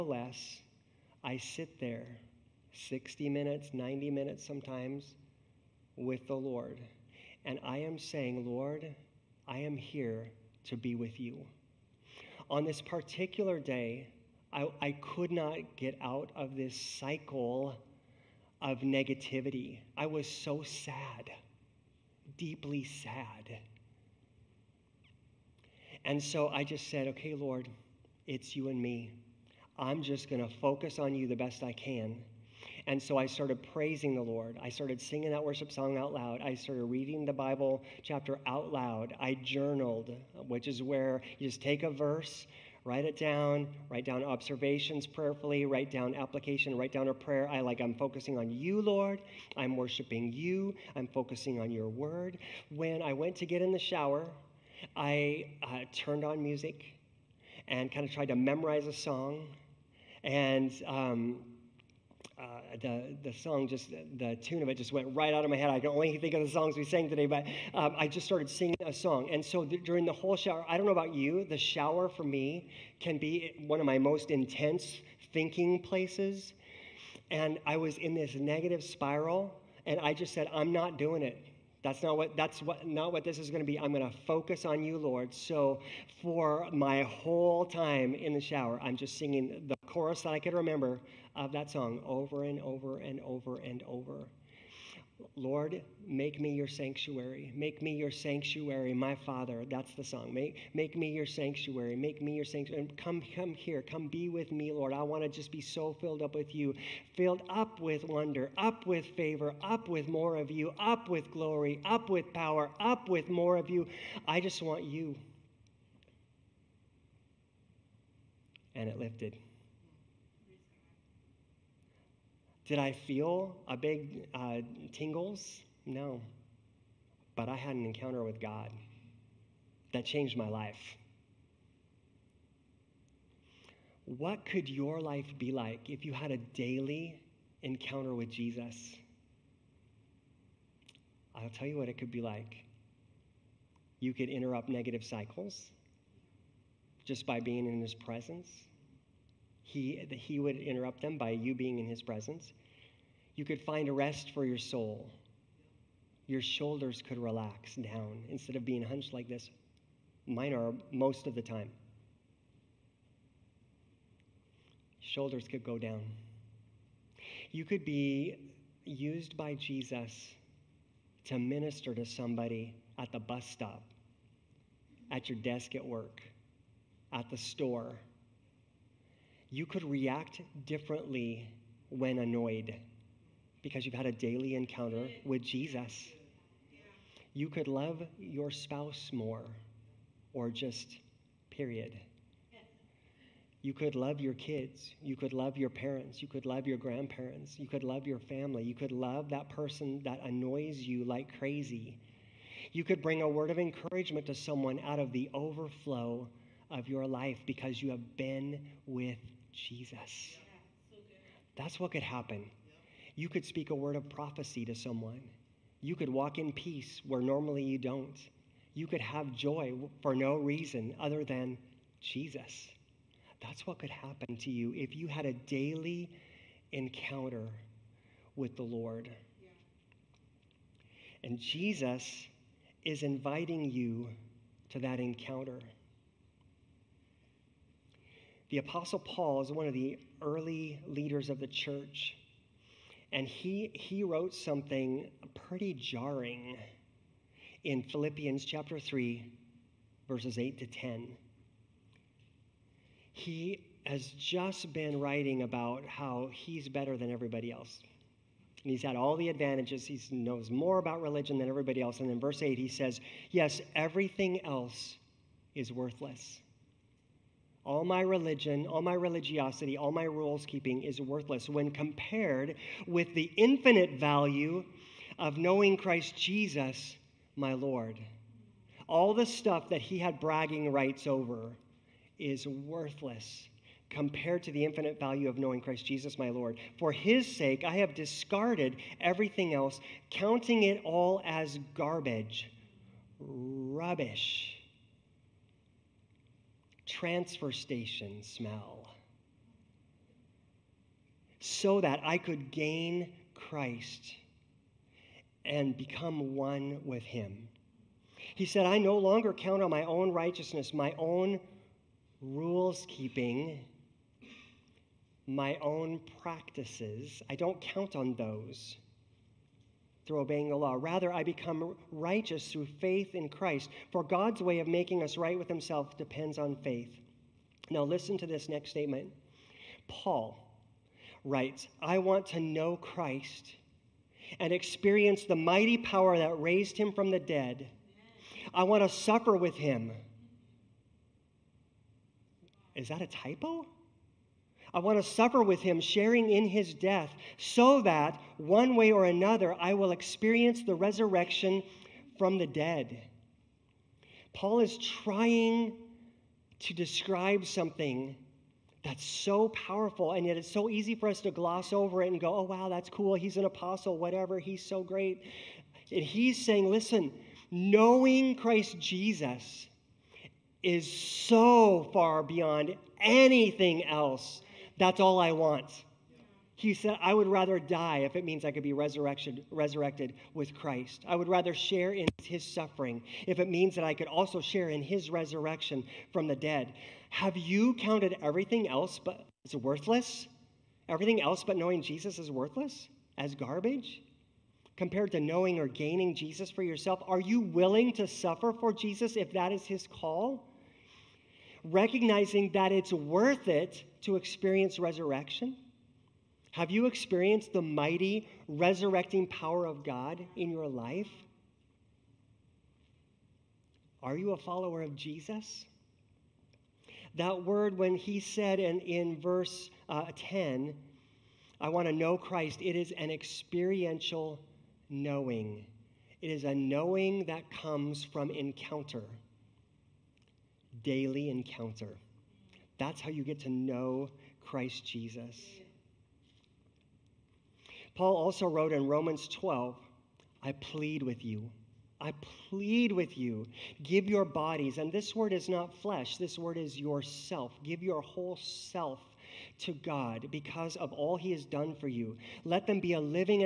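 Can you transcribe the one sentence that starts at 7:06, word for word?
It is a knowing that comes from encounter daily encounter.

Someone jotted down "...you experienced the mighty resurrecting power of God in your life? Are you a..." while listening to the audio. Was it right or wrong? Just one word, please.
right.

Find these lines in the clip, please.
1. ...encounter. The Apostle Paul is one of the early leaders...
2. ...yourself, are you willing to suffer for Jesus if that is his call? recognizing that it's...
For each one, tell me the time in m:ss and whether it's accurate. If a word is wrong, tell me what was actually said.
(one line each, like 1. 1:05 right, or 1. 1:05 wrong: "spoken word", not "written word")
1. 3:55 right
2. 6:36 right.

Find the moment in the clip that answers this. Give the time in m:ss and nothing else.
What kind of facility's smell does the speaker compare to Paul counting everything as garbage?
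4:53.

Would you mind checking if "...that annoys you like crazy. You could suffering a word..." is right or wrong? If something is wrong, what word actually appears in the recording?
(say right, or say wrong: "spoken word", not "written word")
wrong: "bring", not "suffering".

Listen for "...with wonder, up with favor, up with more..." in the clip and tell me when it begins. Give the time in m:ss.
1:47.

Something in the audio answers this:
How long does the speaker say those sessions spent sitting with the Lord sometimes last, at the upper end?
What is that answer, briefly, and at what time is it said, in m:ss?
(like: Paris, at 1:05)
90 minutes, at 0:03.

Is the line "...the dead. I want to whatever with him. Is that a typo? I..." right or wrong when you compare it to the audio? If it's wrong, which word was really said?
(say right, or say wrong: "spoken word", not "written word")
wrong: "suffer", not "whatever".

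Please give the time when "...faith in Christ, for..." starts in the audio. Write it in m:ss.
5:22.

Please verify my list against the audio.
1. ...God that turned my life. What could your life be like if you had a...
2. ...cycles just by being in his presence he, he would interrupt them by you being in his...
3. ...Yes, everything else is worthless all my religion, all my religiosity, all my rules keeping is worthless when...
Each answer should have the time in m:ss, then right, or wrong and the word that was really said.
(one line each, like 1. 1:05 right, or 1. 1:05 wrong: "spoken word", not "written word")
1. 2:08 wrong: "changed", not "turned"
2. 2:25 right
3. 4:23 right.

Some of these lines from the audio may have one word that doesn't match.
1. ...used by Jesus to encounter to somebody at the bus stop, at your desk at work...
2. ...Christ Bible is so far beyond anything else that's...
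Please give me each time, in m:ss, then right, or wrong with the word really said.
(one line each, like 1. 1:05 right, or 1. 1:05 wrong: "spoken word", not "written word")
1. 2:48 wrong: "minister", not "encounter"
2. 6:08 wrong: "Jesus", not "Bible".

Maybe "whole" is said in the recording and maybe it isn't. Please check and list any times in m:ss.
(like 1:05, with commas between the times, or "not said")
1:10, 1:27, 7:28.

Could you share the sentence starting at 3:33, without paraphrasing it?
You could speak a word of prophecy to someone.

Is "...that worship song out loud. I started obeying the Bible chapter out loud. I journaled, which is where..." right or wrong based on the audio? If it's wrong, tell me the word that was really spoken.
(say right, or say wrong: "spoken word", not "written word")
wrong: "reading", not "obeying".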